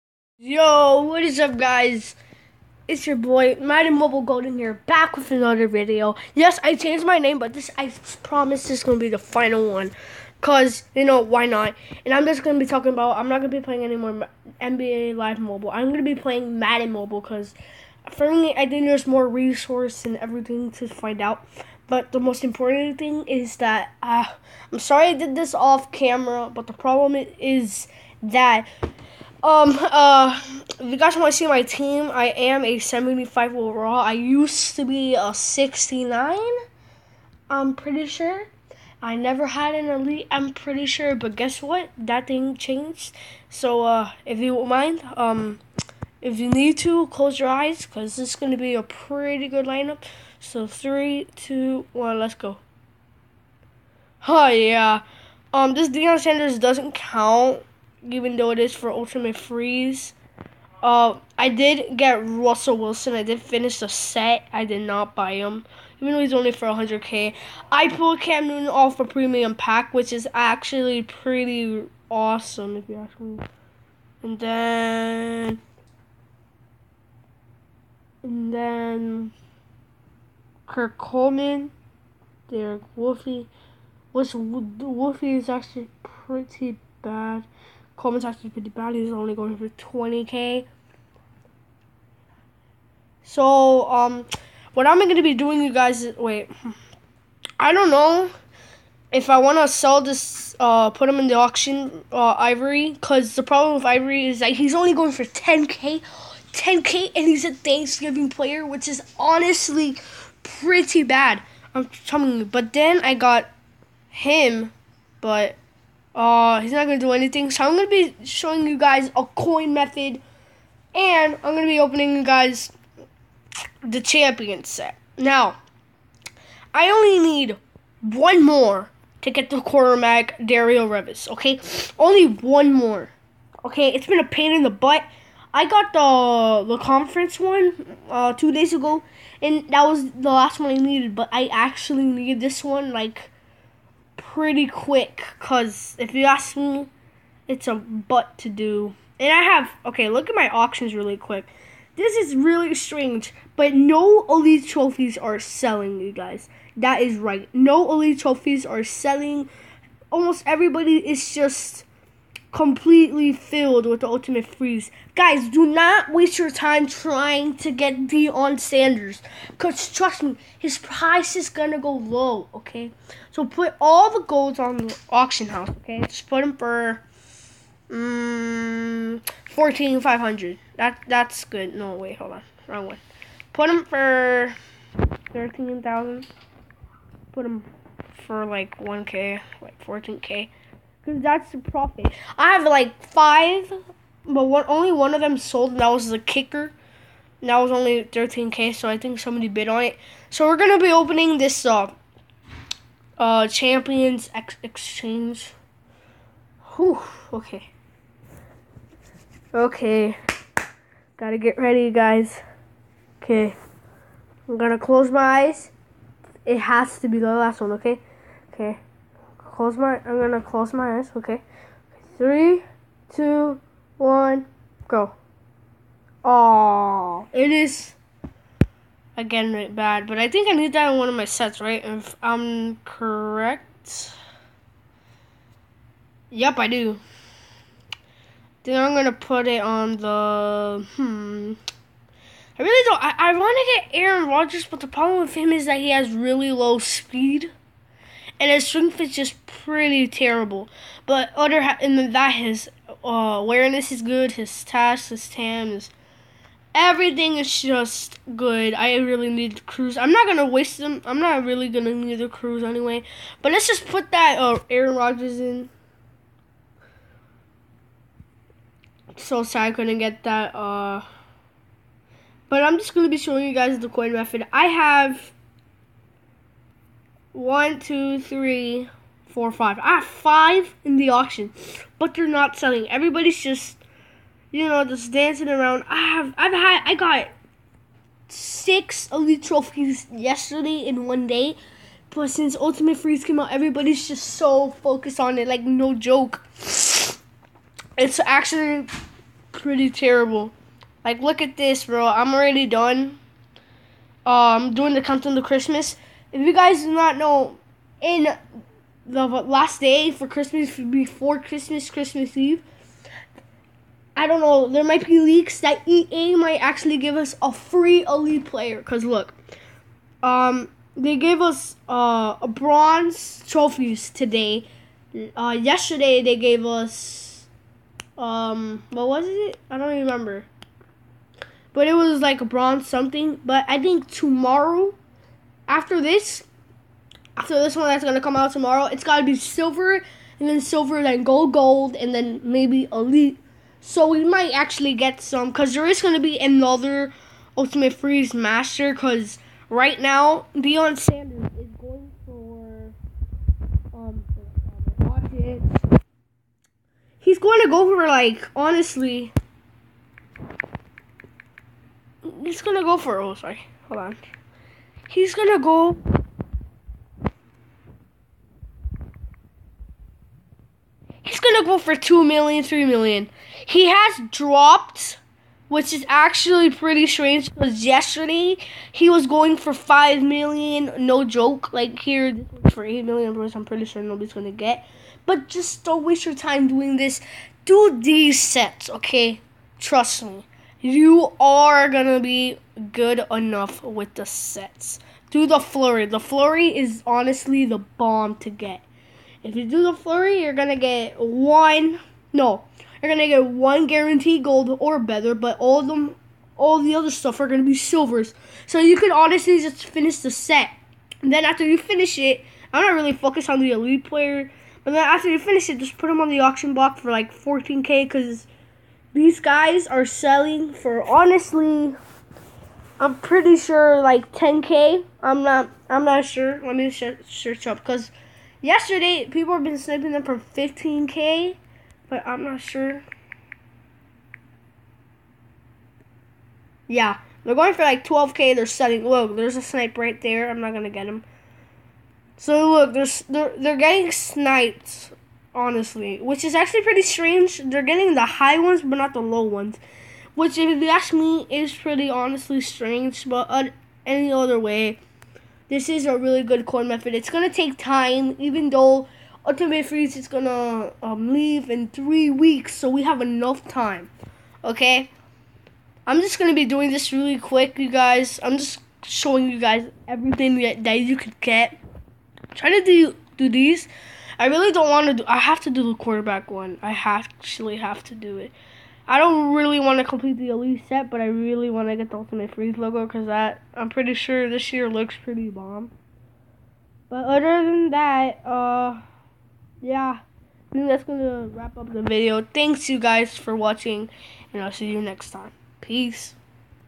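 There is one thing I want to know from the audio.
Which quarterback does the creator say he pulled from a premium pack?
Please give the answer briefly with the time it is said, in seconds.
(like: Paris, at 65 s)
Cam Newton, at 68 s.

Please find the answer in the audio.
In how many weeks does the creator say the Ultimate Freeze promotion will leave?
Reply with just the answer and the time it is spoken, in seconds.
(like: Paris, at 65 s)
3, at 461 s.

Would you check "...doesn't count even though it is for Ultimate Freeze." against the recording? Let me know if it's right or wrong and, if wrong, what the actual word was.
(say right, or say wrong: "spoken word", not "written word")
right.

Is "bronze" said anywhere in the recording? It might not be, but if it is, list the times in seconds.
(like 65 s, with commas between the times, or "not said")
322 s, 332 s.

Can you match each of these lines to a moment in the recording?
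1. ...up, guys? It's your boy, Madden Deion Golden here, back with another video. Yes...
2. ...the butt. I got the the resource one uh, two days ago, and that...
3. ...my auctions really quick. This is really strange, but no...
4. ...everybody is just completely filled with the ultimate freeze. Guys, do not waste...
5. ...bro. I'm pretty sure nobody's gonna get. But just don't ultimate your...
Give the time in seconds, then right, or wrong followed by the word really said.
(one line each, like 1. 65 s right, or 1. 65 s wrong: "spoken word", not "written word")
1. 1 s wrong: "Mobile", not "Deion"
2. 134 s wrong: "conference", not "resource"
3. 150 s right
4. 160 s right
5. 383 s wrong: "waste", not "ultimate".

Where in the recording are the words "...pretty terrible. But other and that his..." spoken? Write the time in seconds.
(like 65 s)
249 s.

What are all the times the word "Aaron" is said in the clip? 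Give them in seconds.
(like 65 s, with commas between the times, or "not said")
244 s, 264 s.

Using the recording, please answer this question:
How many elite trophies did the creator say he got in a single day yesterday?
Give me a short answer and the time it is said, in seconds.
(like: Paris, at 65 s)
6, at 288 s.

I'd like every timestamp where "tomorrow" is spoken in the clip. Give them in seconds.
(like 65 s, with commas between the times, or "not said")
334 s, 338 s.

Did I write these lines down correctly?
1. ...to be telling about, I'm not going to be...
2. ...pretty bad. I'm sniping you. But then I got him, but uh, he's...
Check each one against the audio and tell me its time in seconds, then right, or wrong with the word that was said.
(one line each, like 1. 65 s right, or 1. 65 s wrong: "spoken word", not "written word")
1. 12 s wrong: "talking", not "telling"
2. 110 s wrong: "telling", not "sniping".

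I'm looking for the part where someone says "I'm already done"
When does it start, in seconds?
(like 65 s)
302 s.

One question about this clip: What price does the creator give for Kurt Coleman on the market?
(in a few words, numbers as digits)
20k.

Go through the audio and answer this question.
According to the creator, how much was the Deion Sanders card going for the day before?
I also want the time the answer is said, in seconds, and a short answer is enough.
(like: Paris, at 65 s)
5 million, at 379 s.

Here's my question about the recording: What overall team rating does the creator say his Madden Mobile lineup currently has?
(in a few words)
75.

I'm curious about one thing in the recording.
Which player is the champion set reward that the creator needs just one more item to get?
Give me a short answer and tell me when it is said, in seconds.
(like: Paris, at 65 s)
Darrelle Revis, at 130 s.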